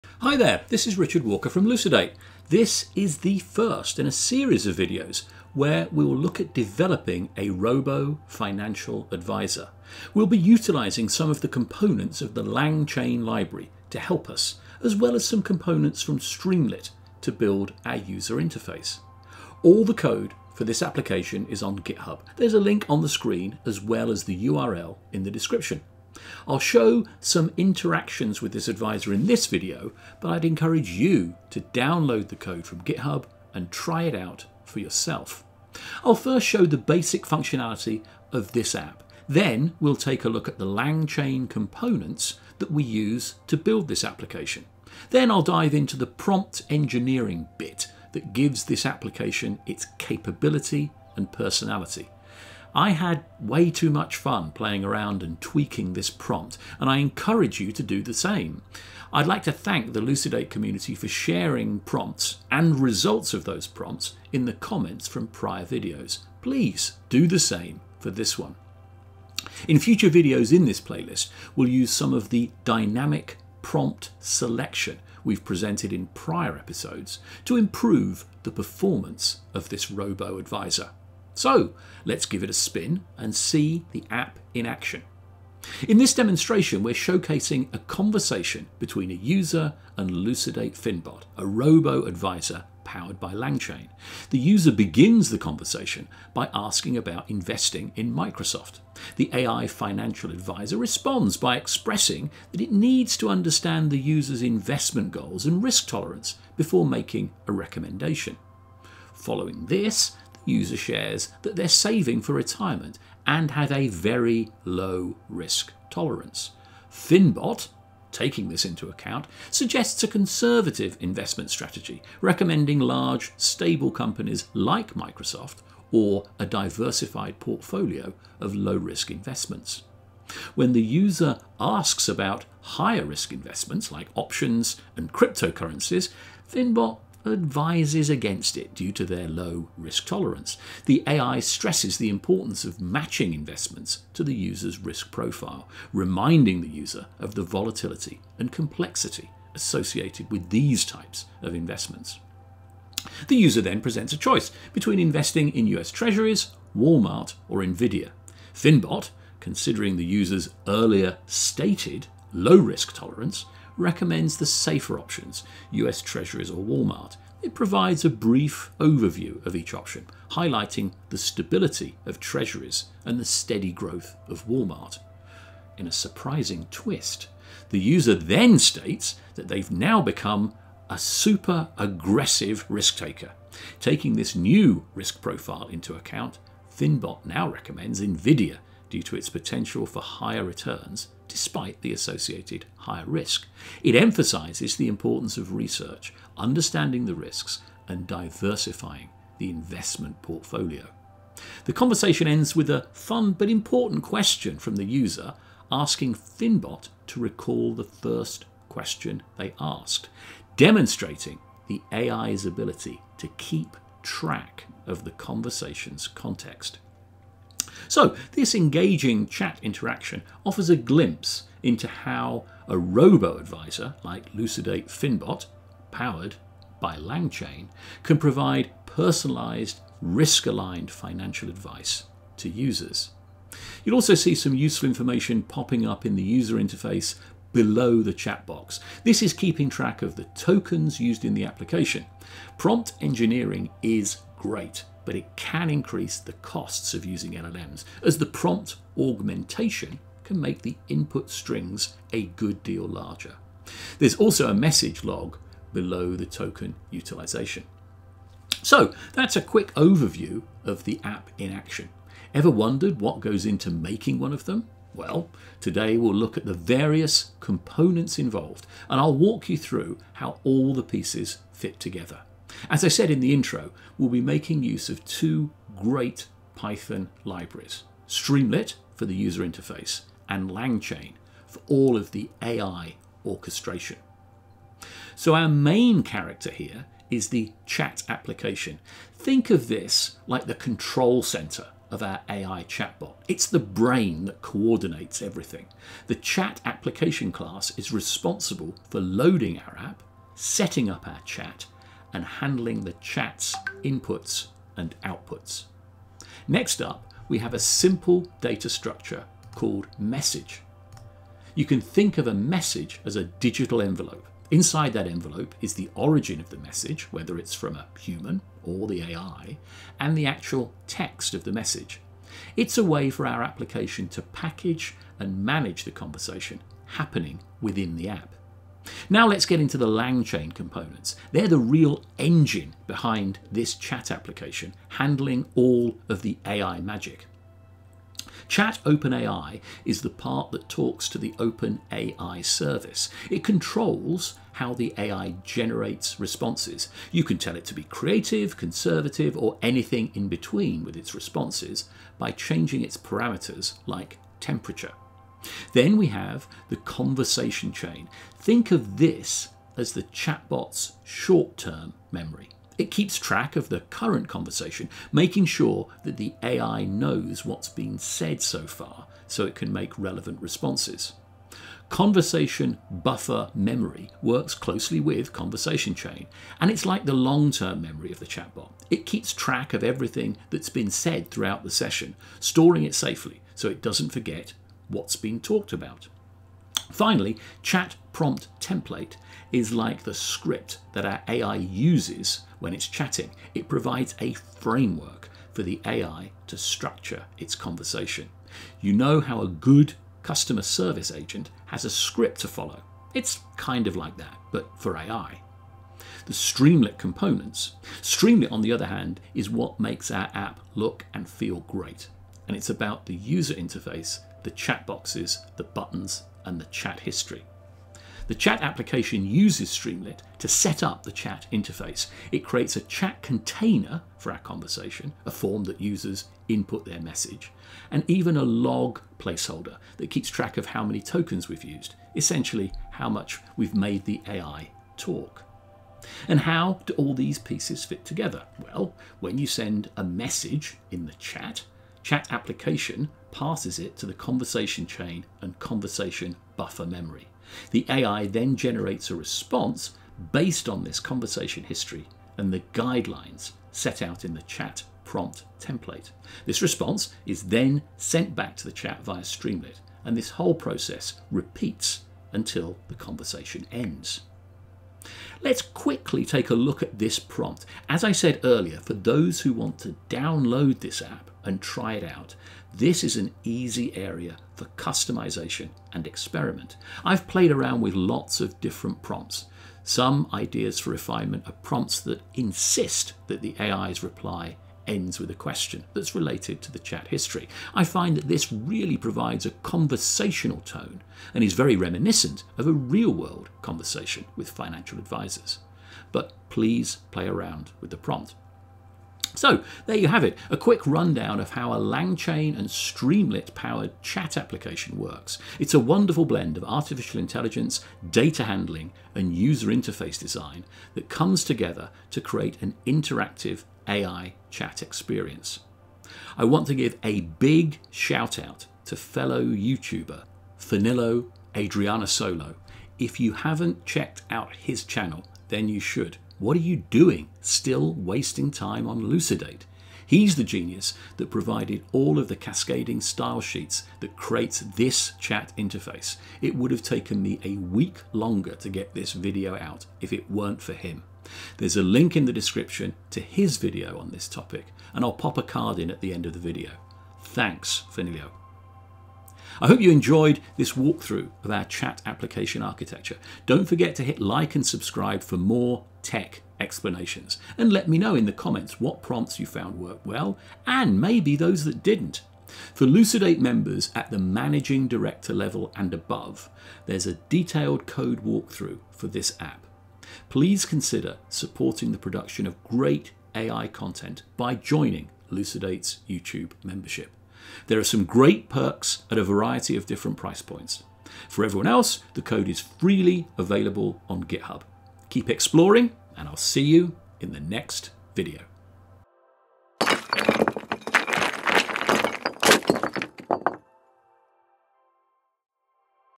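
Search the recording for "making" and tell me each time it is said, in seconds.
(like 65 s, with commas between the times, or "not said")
106 s, 263 s, 274 s, 365 s.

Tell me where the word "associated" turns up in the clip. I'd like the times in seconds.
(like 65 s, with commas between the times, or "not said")
149 s, 191 s.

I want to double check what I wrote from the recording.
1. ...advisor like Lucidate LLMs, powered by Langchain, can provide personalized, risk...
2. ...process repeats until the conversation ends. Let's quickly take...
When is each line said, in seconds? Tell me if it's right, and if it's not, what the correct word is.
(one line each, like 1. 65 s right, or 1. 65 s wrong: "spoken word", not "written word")
1. 223 s wrong: "Finbot", not "LLMs"
2. 460 s right.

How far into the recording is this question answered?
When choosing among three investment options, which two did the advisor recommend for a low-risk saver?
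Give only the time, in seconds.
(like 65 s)
165 s.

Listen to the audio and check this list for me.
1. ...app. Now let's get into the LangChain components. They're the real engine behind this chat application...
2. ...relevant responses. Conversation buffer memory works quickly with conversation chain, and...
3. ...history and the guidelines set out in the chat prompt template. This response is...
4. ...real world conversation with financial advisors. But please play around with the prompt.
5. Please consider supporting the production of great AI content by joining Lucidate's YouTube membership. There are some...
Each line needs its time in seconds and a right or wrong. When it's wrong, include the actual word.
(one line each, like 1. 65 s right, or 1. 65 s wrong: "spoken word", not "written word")
1. 328 s right
2. 369 s wrong: "closely", not "quickly"
3. 451 s right
4. 492 s right
5. 570 s right.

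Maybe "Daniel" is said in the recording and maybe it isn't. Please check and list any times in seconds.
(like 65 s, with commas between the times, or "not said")
not said.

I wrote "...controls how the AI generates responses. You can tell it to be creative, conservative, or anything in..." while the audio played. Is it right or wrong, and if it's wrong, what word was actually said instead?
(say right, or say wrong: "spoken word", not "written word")
right.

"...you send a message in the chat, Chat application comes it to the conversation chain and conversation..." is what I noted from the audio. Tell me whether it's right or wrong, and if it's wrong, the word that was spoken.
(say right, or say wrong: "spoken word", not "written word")
wrong: "passes", not "comes".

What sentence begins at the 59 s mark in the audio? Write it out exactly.
I'd like to thank the Lucidate community for sharing prompts and results of those prompts in the comments from prior videos.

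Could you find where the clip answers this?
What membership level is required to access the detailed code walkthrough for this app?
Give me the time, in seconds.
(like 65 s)
564 s.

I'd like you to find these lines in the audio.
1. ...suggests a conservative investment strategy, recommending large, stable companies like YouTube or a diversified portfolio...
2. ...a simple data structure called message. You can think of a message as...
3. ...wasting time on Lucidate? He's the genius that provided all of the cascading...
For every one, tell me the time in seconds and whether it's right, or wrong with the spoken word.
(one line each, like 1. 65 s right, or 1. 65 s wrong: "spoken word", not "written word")
1. 119 s wrong: "Microsoft", not "YouTube"
2. 307 s right
3. 527 s right.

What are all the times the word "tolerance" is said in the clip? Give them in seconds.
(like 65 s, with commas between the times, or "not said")
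105 s, 115 s, 140 s, 162 s.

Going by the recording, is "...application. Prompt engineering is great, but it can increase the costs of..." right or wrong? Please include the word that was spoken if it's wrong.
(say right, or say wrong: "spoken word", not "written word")
right.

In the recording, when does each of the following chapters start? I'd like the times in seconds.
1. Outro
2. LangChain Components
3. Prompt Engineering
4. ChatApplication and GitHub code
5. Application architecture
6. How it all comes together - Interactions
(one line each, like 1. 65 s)
1. 588 s
2. 85 s
3. 465 s
4. 19 s
5. 284 s
6. 423 s.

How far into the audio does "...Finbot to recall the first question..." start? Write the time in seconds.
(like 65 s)
206 s.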